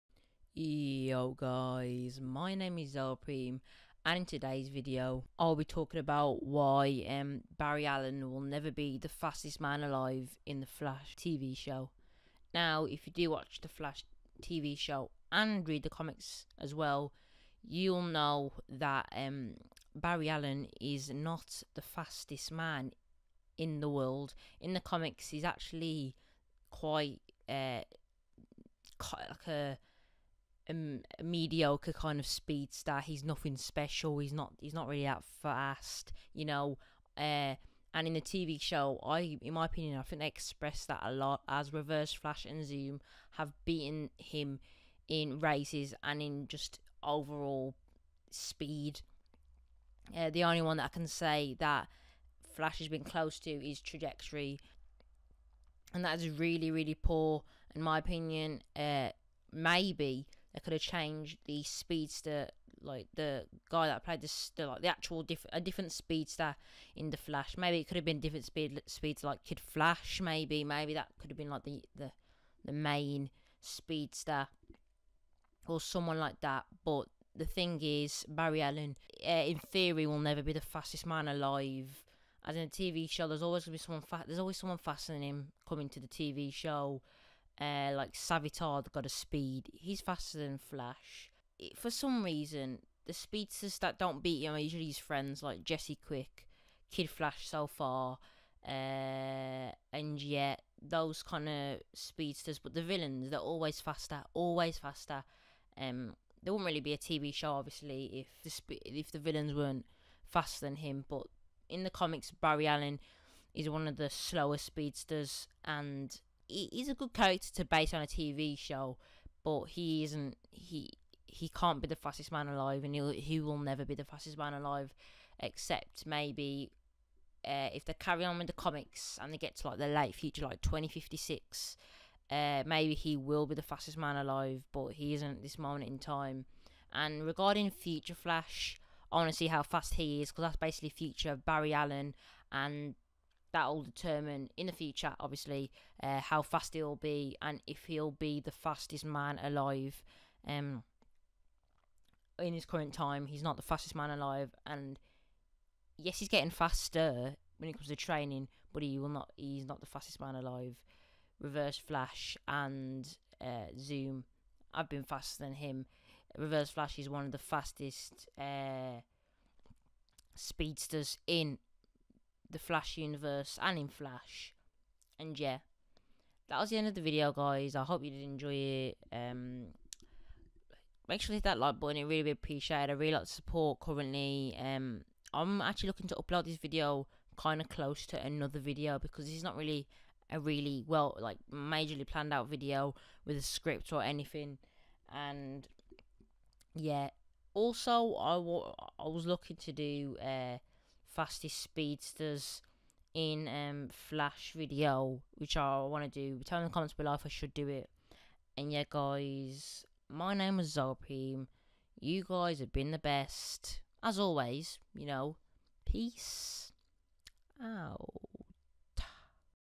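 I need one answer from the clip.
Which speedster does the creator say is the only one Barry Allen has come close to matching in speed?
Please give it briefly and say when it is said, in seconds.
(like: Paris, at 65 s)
Trajectory, at 53 s.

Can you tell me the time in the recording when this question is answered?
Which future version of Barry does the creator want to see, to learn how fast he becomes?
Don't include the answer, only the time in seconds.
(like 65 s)
137 s.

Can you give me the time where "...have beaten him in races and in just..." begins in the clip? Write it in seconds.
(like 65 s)
43 s.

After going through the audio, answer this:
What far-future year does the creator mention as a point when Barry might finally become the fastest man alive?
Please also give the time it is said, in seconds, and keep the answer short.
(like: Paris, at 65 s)
2056, at 130 s.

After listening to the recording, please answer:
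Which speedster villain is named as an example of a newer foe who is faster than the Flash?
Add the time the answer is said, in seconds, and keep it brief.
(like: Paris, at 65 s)
Savitar, at 88 s.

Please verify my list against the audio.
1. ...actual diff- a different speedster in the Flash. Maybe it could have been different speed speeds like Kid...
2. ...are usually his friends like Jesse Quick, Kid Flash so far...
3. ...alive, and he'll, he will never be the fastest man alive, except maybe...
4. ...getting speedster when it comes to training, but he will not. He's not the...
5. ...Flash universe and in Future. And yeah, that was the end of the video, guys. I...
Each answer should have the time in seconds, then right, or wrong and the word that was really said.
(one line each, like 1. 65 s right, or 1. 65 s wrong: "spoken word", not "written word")
1. 64 s right
2. 94 s right
3. 122 s right
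4. 156 s wrong: "faster", not "speedster"
5. 172 s wrong: "Flash", not "Future".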